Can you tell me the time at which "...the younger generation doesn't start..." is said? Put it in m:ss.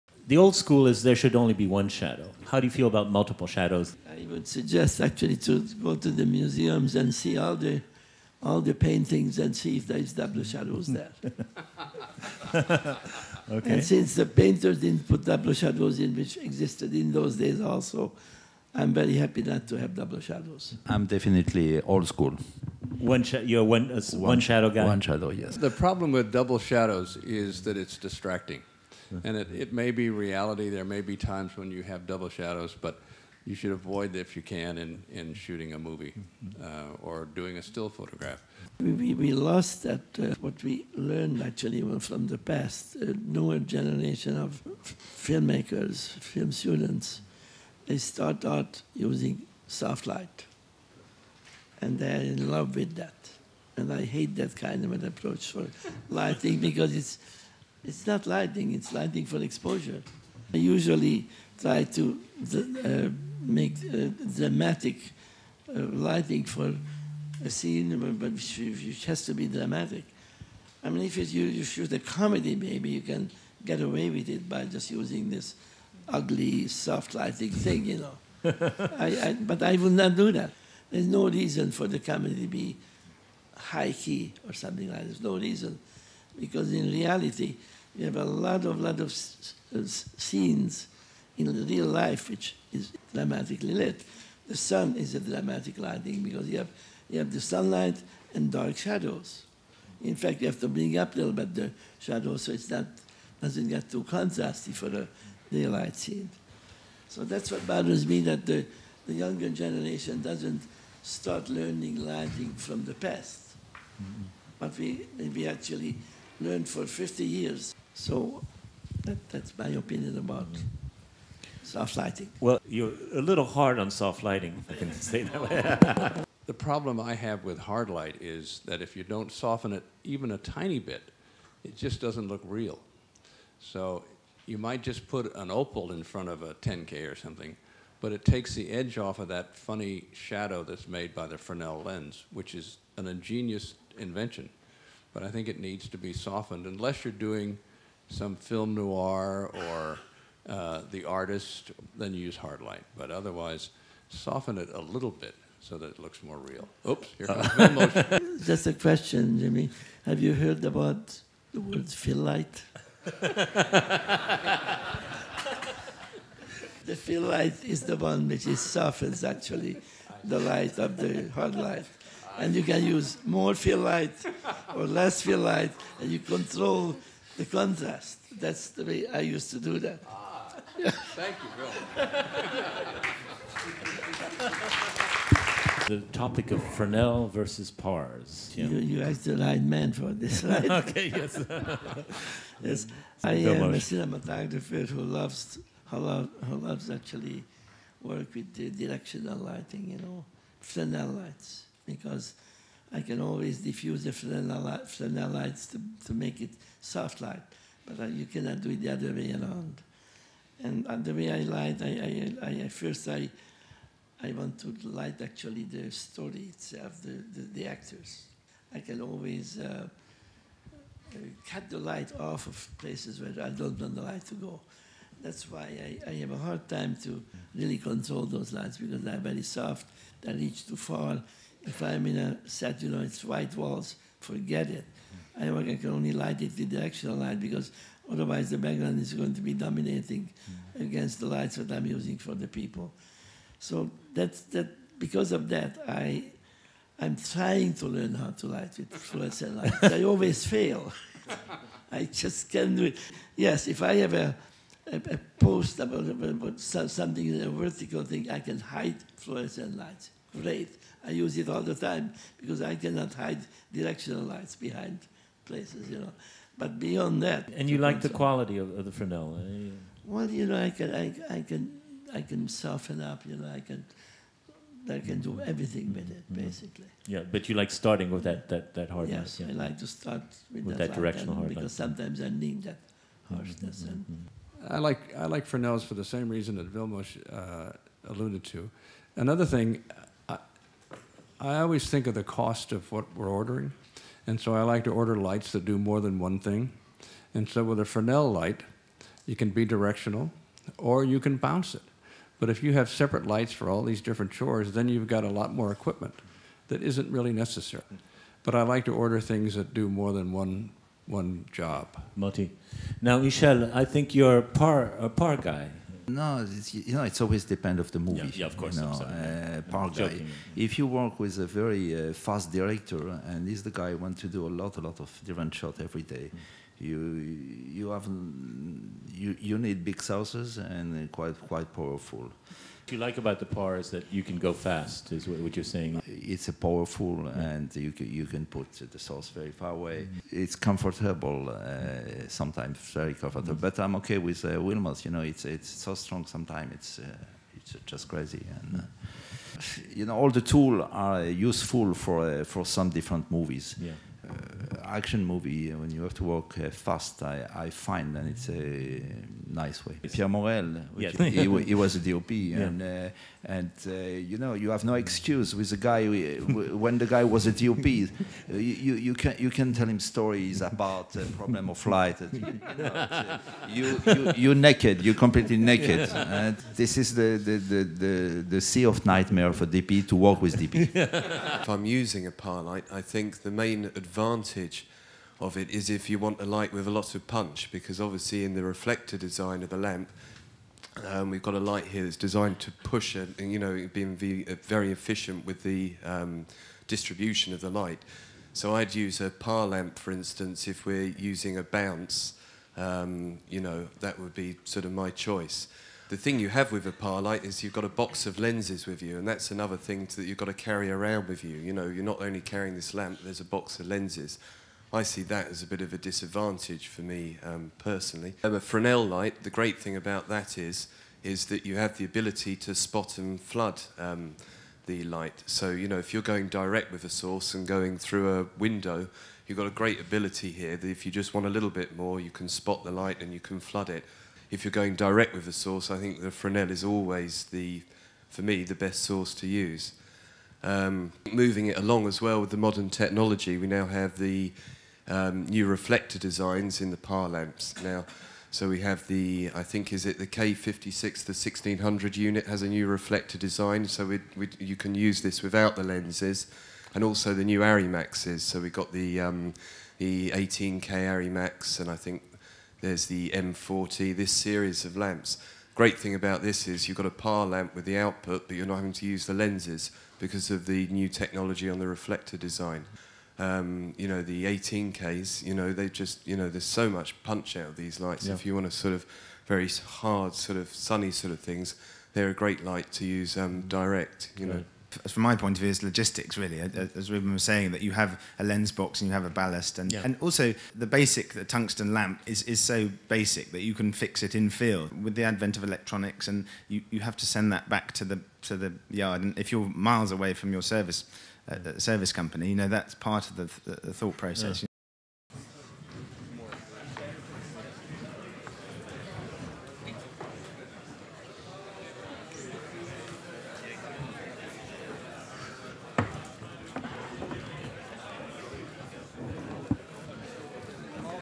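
1:49.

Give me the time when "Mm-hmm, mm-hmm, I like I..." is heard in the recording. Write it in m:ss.
4:43.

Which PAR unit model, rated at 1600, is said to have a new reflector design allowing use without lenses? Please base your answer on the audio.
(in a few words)
K56.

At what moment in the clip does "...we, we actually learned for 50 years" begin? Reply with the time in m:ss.
1:54.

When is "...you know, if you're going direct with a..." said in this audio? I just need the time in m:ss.
7:05.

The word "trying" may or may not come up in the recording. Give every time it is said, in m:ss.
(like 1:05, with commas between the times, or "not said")
4:07.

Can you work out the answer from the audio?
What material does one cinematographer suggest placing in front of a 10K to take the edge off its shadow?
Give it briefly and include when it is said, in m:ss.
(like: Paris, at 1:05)
opal, at 2:15.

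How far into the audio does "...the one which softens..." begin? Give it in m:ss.
2:47.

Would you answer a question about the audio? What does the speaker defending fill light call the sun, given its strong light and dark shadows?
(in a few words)
dramatic lighting.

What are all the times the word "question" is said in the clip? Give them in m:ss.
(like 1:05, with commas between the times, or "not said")
2:38.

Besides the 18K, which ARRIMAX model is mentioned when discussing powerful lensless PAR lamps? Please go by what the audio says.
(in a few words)
M40.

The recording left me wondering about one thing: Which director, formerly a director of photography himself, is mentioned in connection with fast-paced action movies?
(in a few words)
Pierre Morel.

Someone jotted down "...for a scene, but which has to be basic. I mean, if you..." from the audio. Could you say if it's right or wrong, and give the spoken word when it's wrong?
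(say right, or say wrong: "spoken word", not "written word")
wrong: "dramatic", not "basic".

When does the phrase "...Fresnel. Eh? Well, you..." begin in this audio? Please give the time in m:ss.
4:28.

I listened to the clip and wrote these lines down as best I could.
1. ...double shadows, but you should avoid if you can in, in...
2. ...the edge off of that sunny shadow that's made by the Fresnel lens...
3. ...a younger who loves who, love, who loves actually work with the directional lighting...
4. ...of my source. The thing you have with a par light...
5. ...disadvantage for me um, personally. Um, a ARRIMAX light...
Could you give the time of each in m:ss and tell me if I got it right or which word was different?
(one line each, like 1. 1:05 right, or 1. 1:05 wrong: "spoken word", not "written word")
1. 0:32 right
2. 2:18 wrong: "funny", not "sunny"
3. 3:13 wrong: "cinematographer", not "younger"
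4. 6:44 wrong: "choice", not "source"
5. 6:55 wrong: "Fresnel", not "ARRIMAX".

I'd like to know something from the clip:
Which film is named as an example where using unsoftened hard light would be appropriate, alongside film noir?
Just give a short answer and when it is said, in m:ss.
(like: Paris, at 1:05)
The Artist, at 2:30.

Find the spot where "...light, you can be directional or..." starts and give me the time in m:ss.
4:58.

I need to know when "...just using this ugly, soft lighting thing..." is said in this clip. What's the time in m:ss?
1:14.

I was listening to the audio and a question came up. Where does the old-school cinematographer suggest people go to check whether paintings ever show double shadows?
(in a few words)
museums.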